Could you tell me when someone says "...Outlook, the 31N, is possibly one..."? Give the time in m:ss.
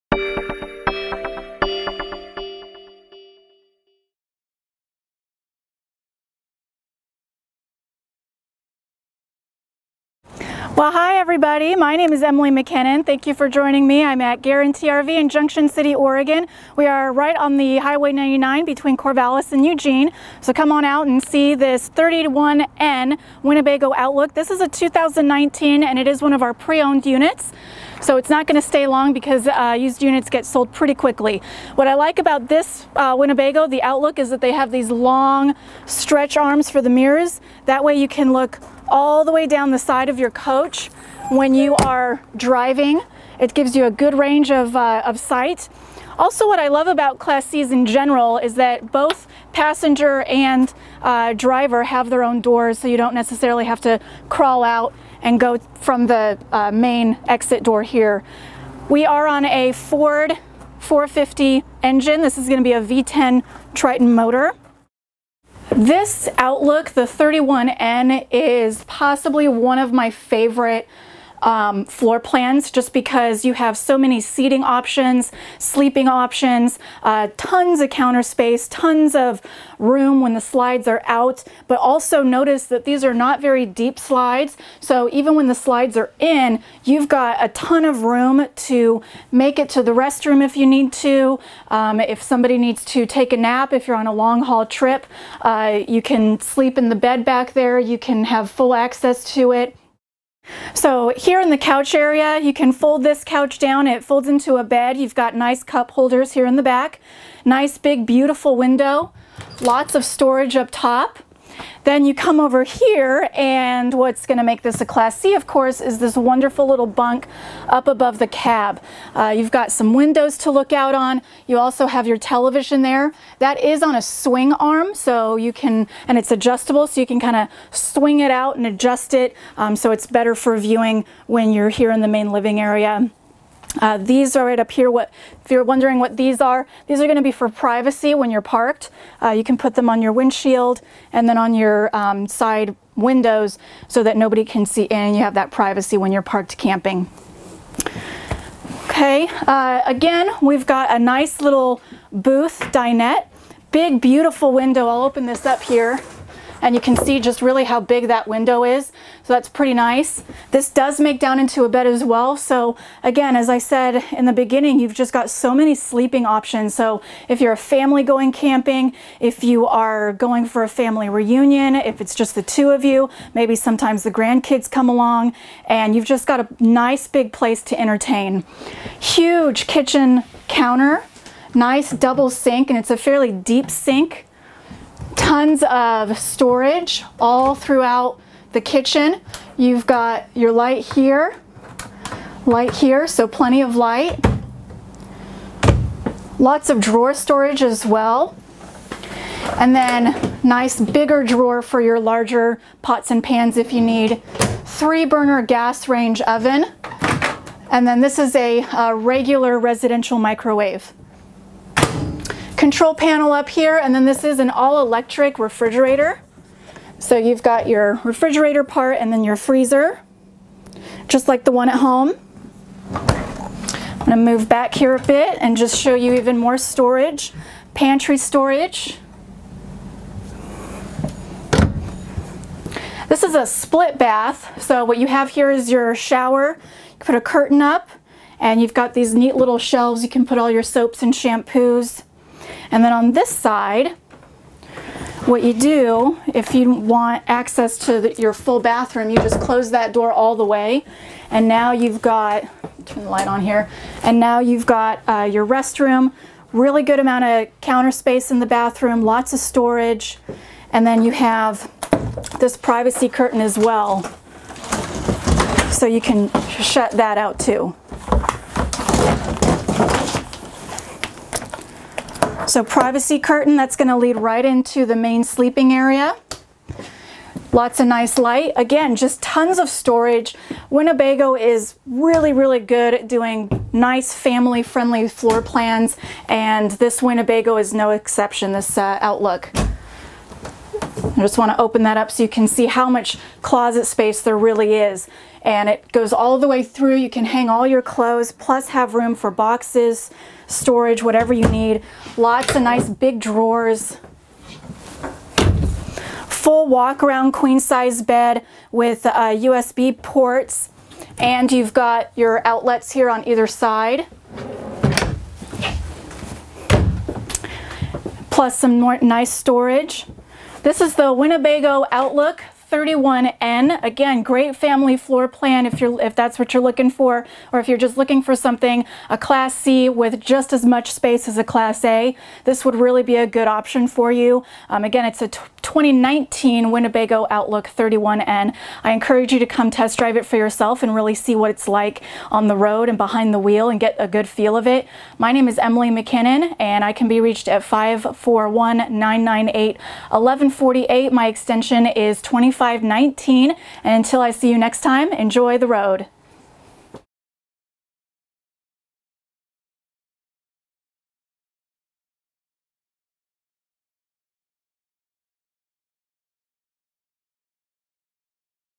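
1:06.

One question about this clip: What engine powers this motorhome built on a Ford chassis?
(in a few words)
V10 Triton.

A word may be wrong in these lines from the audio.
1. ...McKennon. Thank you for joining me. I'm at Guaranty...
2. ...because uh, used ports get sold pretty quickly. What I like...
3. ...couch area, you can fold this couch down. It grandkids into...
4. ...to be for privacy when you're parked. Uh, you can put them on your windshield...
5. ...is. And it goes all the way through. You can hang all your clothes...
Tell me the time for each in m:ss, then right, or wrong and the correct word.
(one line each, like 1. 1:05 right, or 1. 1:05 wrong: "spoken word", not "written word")
1. 0:12 right
2. 0:29 wrong: "units", not "ports"
3. 1:41 wrong: "folds", not "grandkids"
4. 2:17 right
5. 4:54 right.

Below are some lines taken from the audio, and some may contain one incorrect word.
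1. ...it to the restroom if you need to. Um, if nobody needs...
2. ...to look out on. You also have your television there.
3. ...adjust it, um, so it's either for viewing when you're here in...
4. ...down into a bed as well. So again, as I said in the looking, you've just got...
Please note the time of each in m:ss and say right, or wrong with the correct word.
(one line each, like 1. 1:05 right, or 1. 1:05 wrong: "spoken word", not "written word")
1. 1:29 wrong: "somebody", not "nobody"
2. 2:00 right
3. 2:08 wrong: "better", not "either"
4. 2:41 wrong: "beginning", not "looking".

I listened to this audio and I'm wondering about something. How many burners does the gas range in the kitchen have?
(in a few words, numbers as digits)
3.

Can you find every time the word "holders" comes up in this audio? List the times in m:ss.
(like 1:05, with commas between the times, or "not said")
1:45.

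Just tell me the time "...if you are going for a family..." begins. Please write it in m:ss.
2:49.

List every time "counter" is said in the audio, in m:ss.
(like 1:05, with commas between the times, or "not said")
1:17, 3:00, 4:17.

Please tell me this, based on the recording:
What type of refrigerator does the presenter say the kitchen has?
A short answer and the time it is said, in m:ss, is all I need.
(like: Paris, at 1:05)
All-electric, at 3:34.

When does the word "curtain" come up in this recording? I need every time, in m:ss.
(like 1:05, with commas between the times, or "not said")
3:57, 4:23, 4:33.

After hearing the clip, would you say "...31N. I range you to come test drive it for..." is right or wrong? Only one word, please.
wrong.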